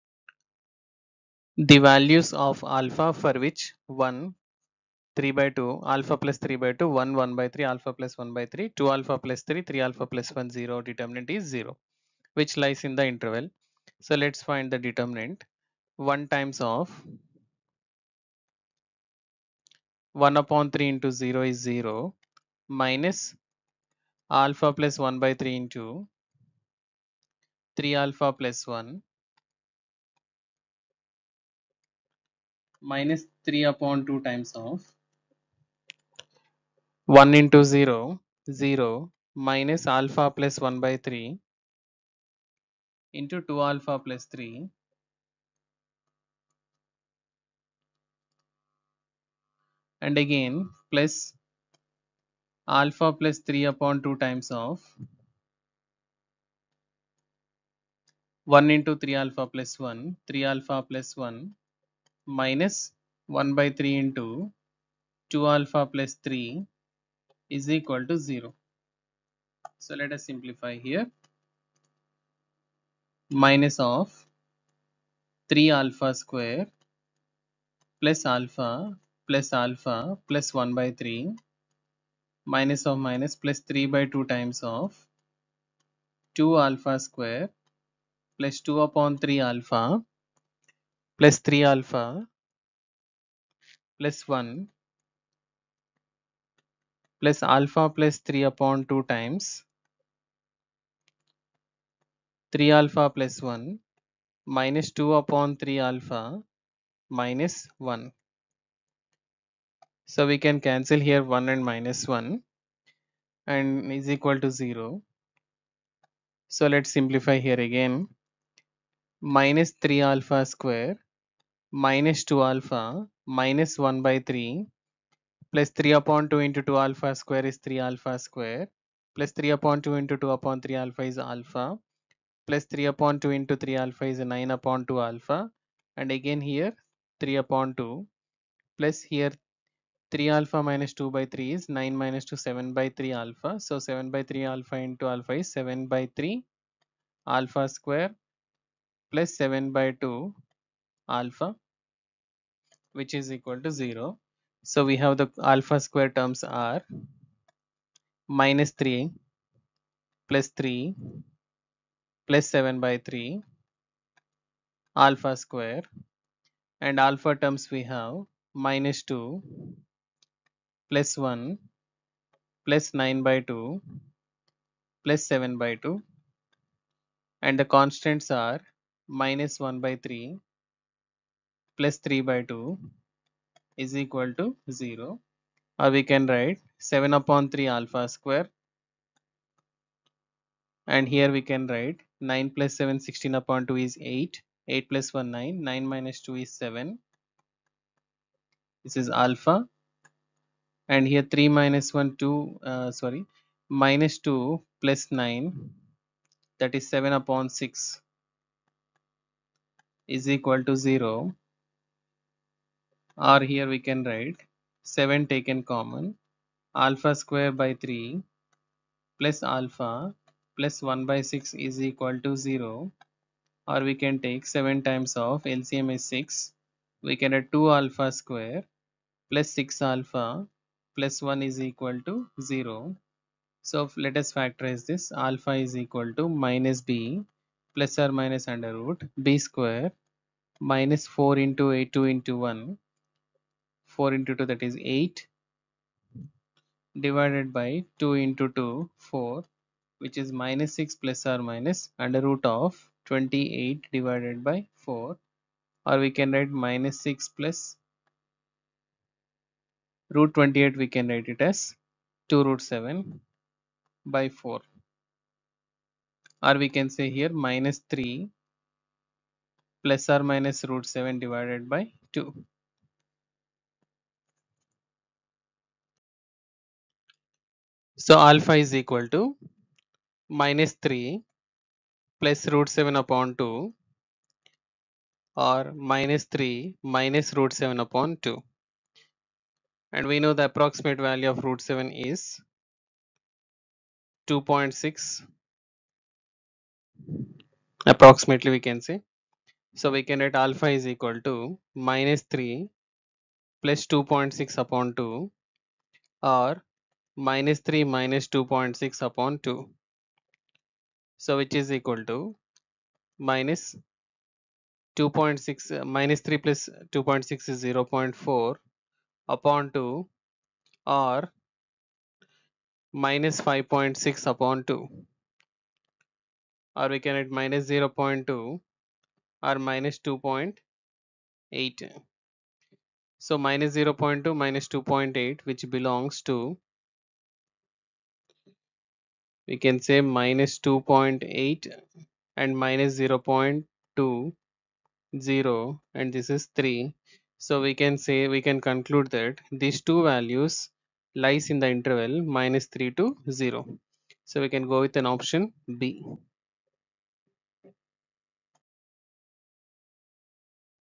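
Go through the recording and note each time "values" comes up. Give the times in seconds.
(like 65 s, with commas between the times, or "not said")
1 s, 290 s, 350 s.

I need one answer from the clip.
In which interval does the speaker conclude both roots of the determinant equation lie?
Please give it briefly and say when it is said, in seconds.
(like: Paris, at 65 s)
-3 to 0, at 352 s.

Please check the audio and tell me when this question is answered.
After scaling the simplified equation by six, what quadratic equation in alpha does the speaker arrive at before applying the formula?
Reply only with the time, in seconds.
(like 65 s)
227 s.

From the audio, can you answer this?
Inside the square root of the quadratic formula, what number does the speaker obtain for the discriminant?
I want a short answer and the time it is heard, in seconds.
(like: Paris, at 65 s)
28, at 252 s.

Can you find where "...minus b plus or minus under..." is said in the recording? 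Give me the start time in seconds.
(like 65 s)
236 s.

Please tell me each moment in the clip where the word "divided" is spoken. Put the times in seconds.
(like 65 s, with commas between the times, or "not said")
247 s, 253 s, 271 s.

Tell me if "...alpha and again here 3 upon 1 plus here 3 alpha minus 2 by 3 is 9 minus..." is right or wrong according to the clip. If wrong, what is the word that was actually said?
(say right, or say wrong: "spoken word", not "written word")
wrong: "2", not "1".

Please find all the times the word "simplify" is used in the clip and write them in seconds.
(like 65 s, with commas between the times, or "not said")
70 s, 116 s.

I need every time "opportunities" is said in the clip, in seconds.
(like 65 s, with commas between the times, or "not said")
not said.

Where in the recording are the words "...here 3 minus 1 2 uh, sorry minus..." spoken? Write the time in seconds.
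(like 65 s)
201 s.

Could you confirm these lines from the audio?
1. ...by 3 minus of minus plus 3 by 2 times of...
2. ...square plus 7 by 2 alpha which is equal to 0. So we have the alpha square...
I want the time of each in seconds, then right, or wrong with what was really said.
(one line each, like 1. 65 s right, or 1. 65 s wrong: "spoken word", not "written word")
1. 80 s right
2. 147 s right.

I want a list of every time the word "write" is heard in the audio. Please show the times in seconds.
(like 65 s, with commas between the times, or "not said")
186 s, 191 s, 214 s, 256 s, 261 s.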